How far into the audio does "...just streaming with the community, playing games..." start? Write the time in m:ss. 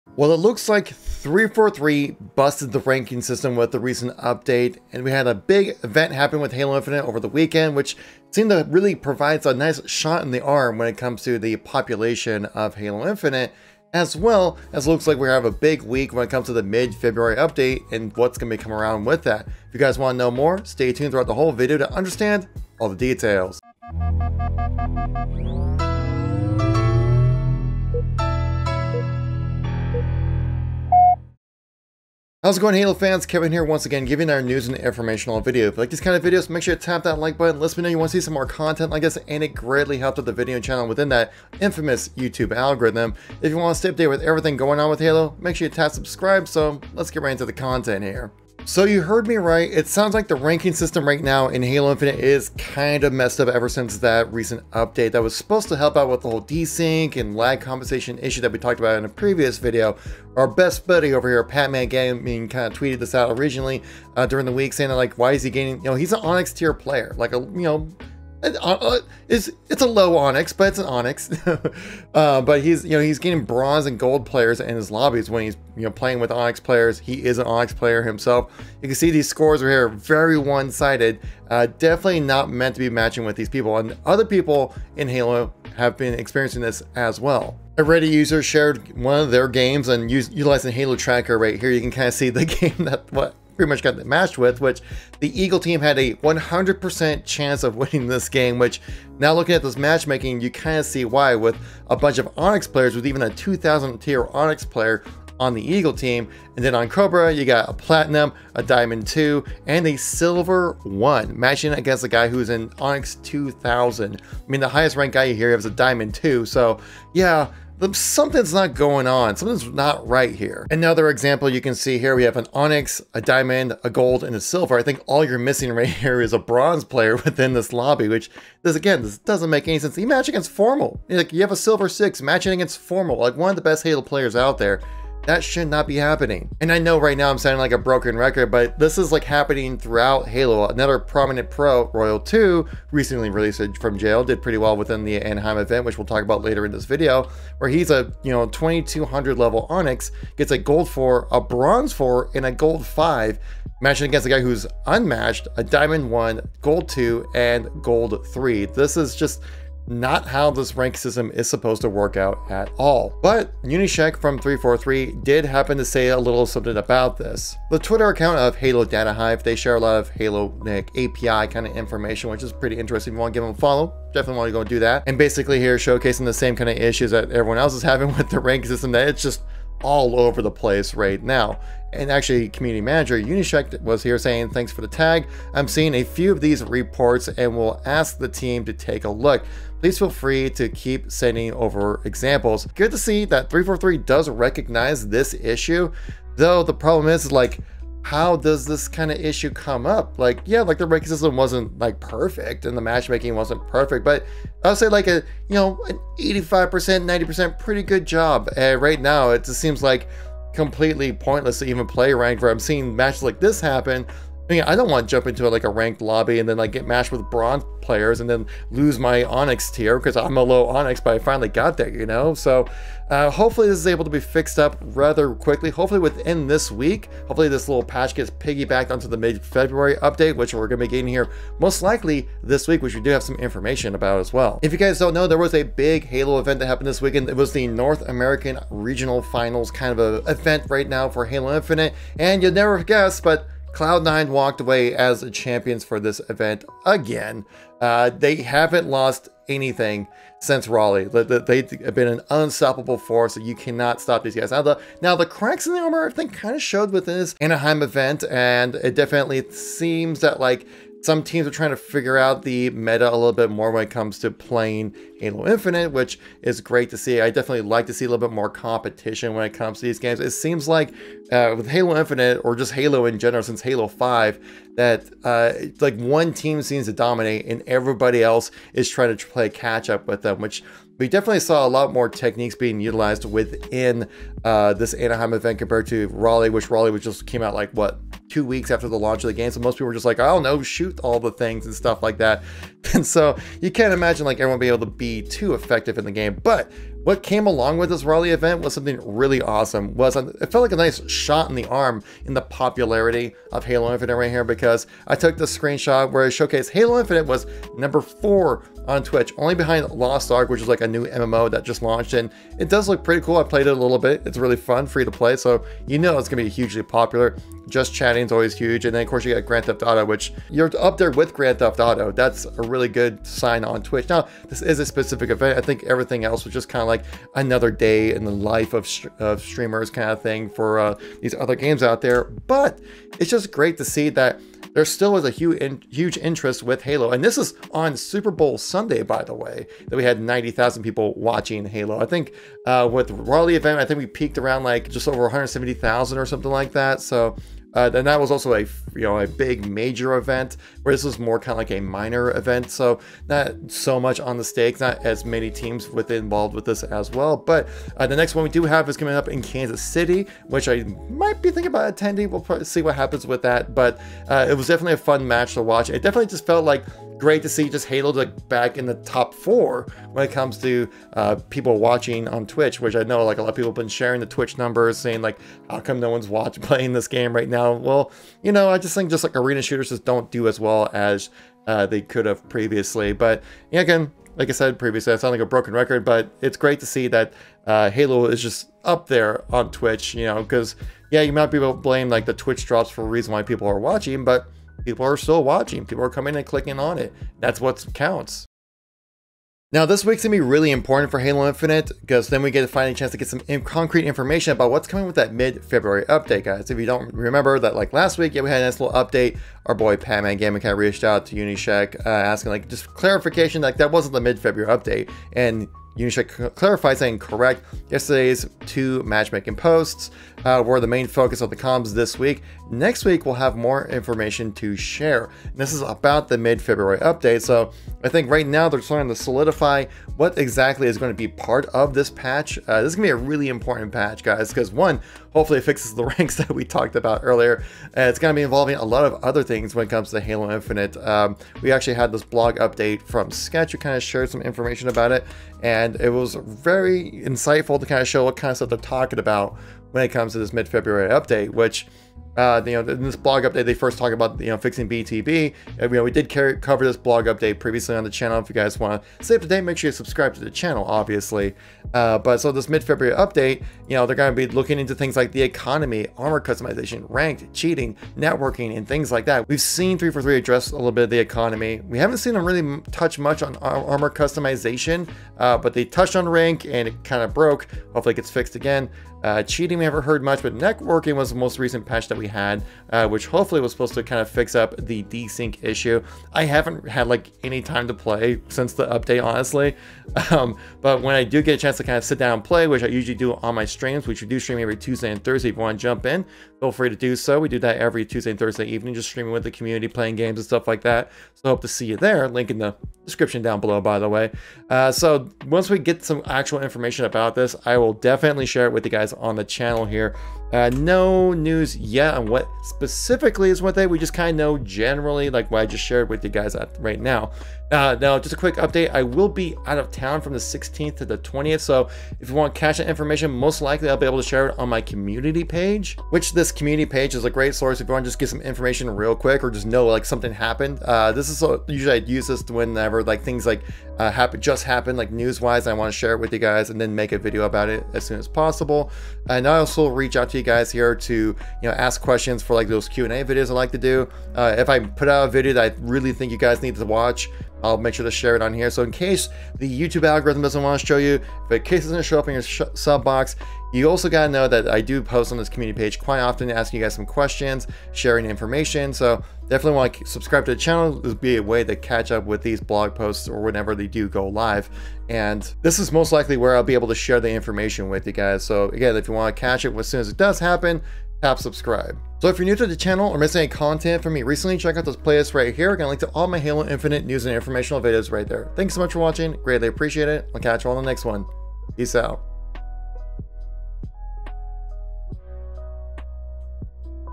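8:18.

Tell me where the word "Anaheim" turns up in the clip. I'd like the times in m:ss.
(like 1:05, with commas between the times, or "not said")
2:25, 4:17, 4:44.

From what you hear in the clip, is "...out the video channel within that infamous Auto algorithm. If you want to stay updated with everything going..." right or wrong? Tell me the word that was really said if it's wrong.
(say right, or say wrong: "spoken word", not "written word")
wrong: "YouTube", not "Auto".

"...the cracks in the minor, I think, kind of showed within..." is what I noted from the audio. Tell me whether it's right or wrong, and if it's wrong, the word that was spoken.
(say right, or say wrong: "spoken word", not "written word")
wrong: "armor", not "minor".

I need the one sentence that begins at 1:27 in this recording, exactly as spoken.
A Reddit user shared one of their games and utilizing Halo Tracker right here.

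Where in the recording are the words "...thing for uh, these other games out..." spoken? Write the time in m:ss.
5:30.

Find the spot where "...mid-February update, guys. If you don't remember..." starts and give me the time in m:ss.
6:45.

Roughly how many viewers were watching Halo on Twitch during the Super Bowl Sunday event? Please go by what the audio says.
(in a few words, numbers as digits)
90,000.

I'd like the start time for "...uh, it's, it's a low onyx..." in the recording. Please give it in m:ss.
1:08.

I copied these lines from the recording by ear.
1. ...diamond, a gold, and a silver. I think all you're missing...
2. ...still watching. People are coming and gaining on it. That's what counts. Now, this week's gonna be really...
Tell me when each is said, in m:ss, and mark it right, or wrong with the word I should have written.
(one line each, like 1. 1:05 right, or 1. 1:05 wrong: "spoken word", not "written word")
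1. 2:03 right
2. 6:35 wrong: "clicking", not "gaining".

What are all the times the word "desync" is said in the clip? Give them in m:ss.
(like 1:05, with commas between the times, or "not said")
0:56, 8:05.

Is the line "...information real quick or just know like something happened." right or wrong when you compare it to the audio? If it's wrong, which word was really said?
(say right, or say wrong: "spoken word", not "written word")
right.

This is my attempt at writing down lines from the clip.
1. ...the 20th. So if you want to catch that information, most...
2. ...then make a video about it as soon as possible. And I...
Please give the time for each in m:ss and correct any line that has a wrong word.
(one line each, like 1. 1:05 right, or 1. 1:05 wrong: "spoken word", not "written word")
1. 8:41 right
2. 8:56 right.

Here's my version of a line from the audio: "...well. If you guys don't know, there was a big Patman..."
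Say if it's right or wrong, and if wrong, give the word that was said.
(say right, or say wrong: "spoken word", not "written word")
wrong: "Halo", not "Patman".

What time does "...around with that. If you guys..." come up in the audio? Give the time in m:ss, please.
0:18.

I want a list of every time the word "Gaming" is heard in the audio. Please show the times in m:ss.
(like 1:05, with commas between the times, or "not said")
1:01, 6:50.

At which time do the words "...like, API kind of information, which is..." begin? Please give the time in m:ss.
2:50.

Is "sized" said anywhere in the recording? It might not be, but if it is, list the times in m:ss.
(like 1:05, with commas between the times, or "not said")
not said.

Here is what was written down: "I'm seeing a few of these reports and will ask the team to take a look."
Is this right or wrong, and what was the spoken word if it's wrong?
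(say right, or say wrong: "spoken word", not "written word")
right.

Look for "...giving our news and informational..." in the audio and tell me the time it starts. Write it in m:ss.
0:34.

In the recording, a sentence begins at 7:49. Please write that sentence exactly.
We've seen 343 address a little bit of the economy.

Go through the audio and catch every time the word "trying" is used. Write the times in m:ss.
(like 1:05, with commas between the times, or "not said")
4:21, 4:38.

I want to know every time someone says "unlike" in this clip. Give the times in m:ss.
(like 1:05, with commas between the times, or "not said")
not said.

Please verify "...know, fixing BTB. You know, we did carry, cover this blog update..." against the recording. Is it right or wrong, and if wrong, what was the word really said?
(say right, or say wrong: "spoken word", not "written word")
right.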